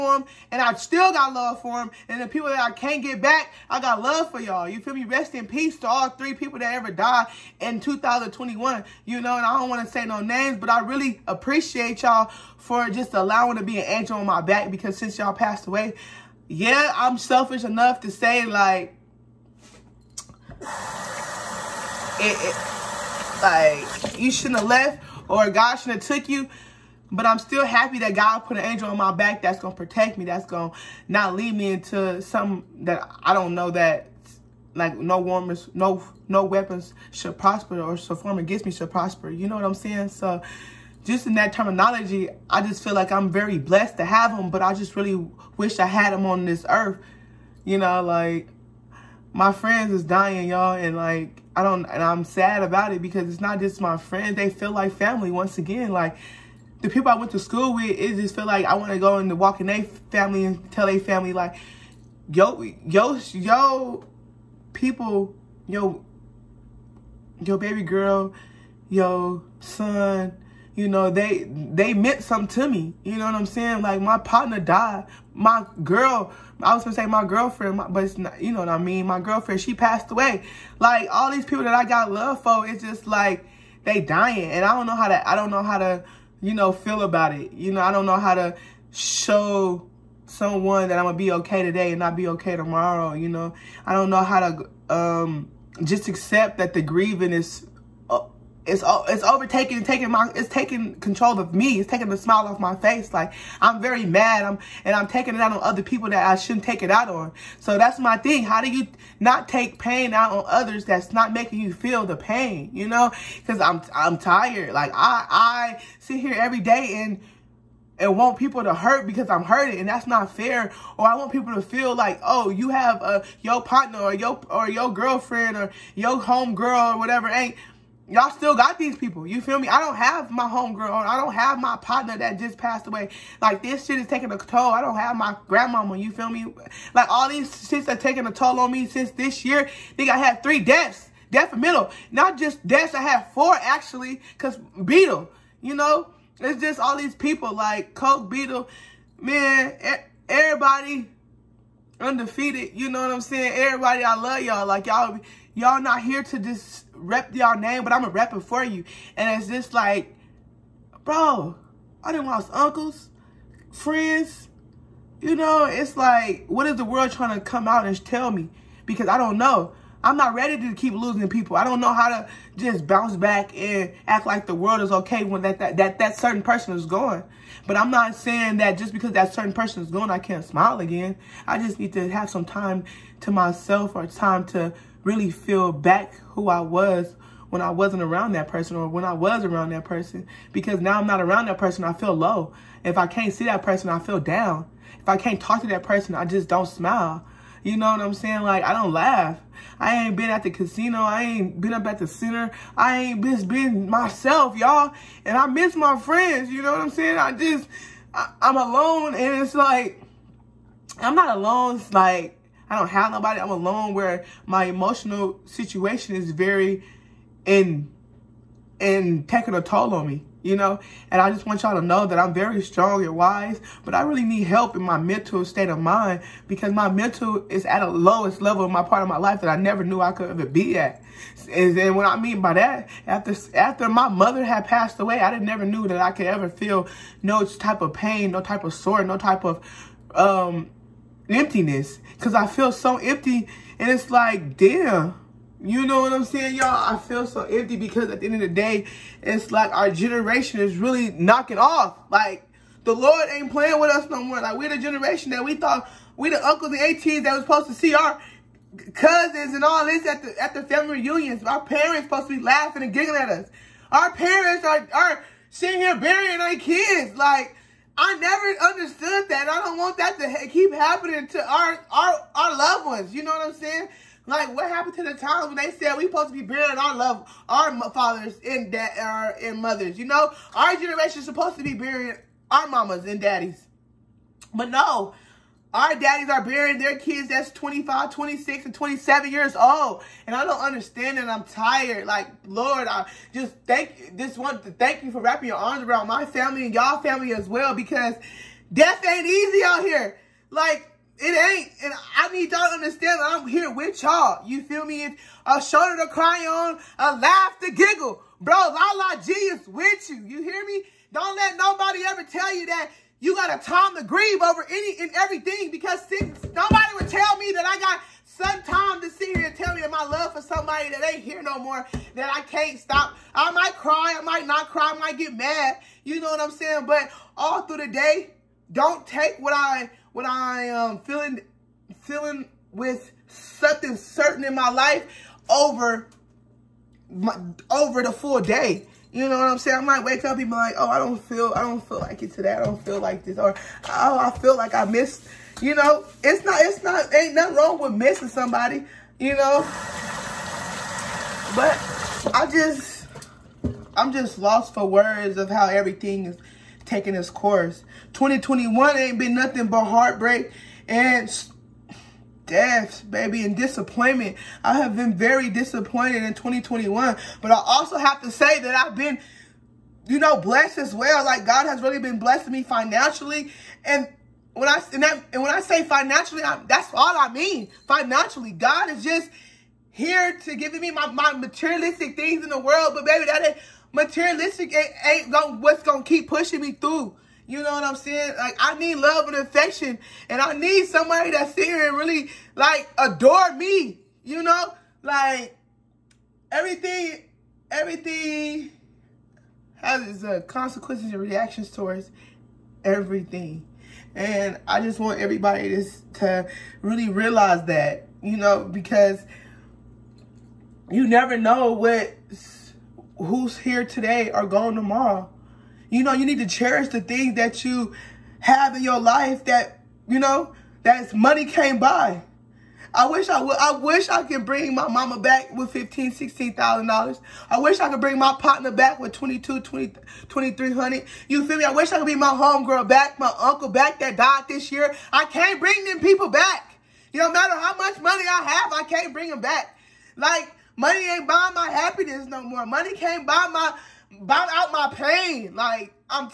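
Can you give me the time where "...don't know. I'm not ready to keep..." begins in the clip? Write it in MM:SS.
02:49.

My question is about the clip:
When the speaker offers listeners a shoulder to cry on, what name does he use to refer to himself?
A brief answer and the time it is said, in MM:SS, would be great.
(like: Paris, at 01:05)
La La G, at 05:08.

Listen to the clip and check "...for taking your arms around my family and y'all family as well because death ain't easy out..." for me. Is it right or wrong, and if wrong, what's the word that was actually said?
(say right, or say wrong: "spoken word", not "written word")
wrong: "wrapping", not "taking".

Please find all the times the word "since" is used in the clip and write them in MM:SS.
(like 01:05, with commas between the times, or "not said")
00:14, 02:18.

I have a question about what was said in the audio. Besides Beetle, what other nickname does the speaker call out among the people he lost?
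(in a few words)
Coke.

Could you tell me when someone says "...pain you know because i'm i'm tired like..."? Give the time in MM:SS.
01:52.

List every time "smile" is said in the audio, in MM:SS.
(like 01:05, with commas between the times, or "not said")
01:42, 03:00, 03:16.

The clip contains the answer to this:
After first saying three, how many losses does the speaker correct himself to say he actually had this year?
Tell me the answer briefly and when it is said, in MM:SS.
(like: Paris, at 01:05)
4, at 02:23.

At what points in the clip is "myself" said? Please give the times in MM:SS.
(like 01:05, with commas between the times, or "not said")
03:03, 03:23.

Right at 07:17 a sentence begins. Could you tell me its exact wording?
You no matter how much money I have, I can't bring them back.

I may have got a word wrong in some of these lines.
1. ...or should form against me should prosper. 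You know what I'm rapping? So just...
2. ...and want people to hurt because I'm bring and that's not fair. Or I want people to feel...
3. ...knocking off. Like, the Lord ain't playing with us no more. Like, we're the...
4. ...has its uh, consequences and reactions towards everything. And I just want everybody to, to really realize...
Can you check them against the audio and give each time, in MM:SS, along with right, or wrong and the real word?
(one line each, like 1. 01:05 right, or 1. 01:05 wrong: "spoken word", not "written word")
1. 00:37 wrong: "saying", not "rapping"
2. 01:57 wrong: "hurting", not "bring"
3. 04:11 right
4. 06:39 right.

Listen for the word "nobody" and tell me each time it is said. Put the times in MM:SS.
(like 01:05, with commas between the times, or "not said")
03:33, 05:11, 05:16.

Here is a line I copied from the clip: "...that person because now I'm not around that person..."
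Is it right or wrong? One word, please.
right.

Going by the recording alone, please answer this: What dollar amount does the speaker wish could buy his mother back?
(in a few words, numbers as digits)
$15,000-16,000.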